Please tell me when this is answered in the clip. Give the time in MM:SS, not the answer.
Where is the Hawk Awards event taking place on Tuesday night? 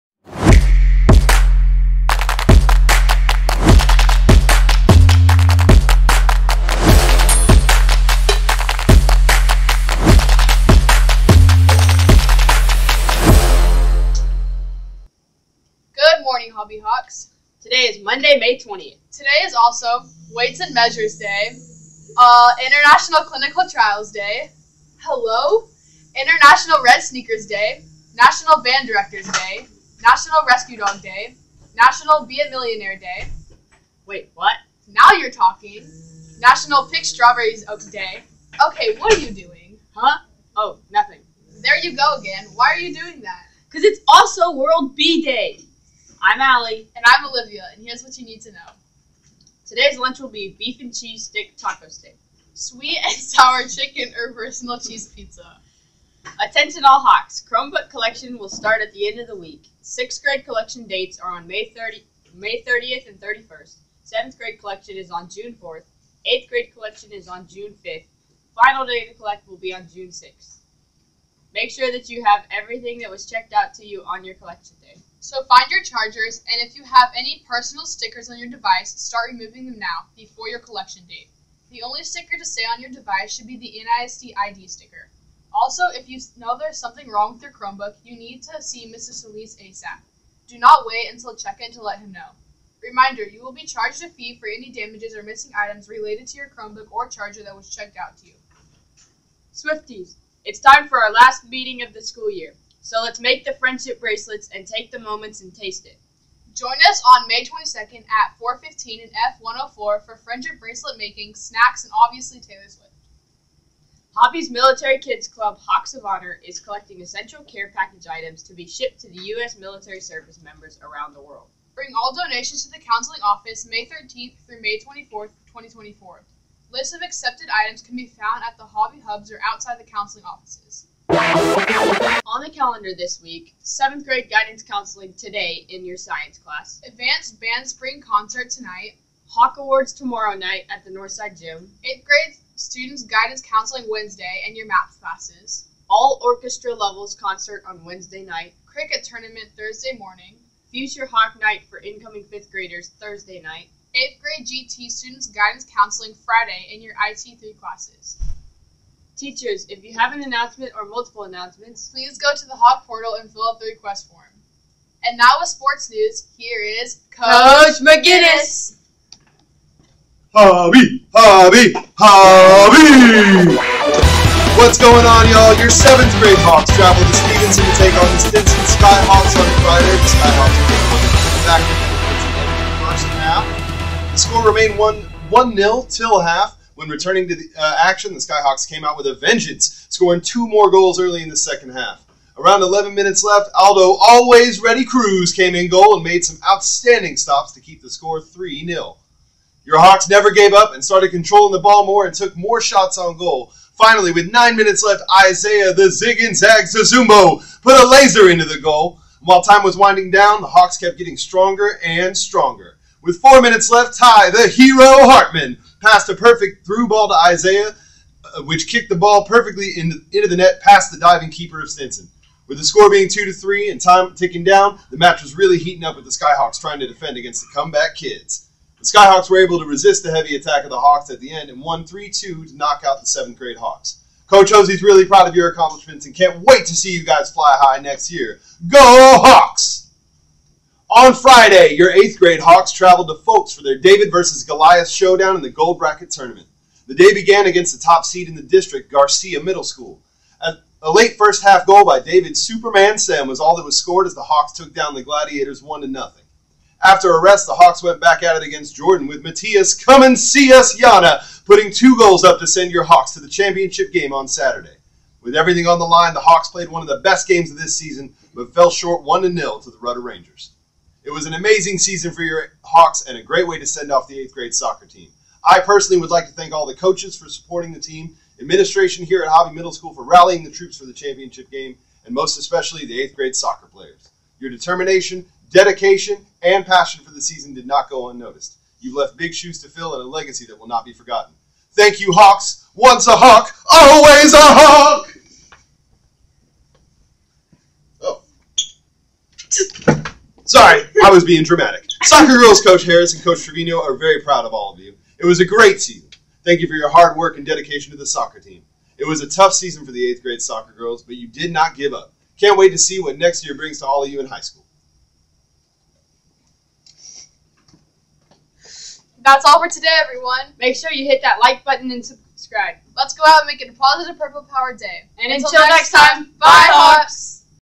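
02:20.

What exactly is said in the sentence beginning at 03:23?
Finally, with nine minutes left, Isaiah the zig and zag Zazumbo put a laser into the goal.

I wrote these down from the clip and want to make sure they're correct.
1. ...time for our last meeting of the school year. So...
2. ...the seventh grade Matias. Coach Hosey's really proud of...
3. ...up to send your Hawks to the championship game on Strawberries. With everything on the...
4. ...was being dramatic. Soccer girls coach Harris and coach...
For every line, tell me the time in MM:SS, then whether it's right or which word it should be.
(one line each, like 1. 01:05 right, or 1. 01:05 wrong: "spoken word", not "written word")
1. 01:40 right
2. 03:52 wrong: "Hawks", not "Matias"
3. 04:22 wrong: "Saturday", not "Strawberries"
4. 05:01 right.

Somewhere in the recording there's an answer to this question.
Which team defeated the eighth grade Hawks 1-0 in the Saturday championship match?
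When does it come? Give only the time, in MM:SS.
04:29.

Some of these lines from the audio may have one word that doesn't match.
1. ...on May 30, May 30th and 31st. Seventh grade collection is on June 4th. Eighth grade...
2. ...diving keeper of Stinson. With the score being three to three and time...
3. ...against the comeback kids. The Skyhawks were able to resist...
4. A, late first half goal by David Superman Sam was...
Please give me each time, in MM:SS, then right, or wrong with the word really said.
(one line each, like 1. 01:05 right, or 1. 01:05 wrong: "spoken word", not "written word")
1. 01:01 right
2. 03:40 wrong: "two", not "three"
3. 03:47 right
4. 04:10 right.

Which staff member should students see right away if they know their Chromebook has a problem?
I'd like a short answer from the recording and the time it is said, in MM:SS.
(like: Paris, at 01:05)
Mr. Solis, at 01:28.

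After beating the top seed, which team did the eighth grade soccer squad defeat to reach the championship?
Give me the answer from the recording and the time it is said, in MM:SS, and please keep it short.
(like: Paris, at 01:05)
Jordan, at 04:18.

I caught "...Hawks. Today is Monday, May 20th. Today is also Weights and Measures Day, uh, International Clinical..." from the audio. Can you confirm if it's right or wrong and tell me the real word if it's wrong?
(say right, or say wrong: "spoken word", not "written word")
right.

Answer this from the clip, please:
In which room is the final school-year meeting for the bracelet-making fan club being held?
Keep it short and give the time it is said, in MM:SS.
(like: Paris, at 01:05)
F104, at 01:49.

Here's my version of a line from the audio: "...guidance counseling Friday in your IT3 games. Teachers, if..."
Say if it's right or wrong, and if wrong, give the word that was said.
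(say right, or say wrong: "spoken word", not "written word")
wrong: "classes", not "games".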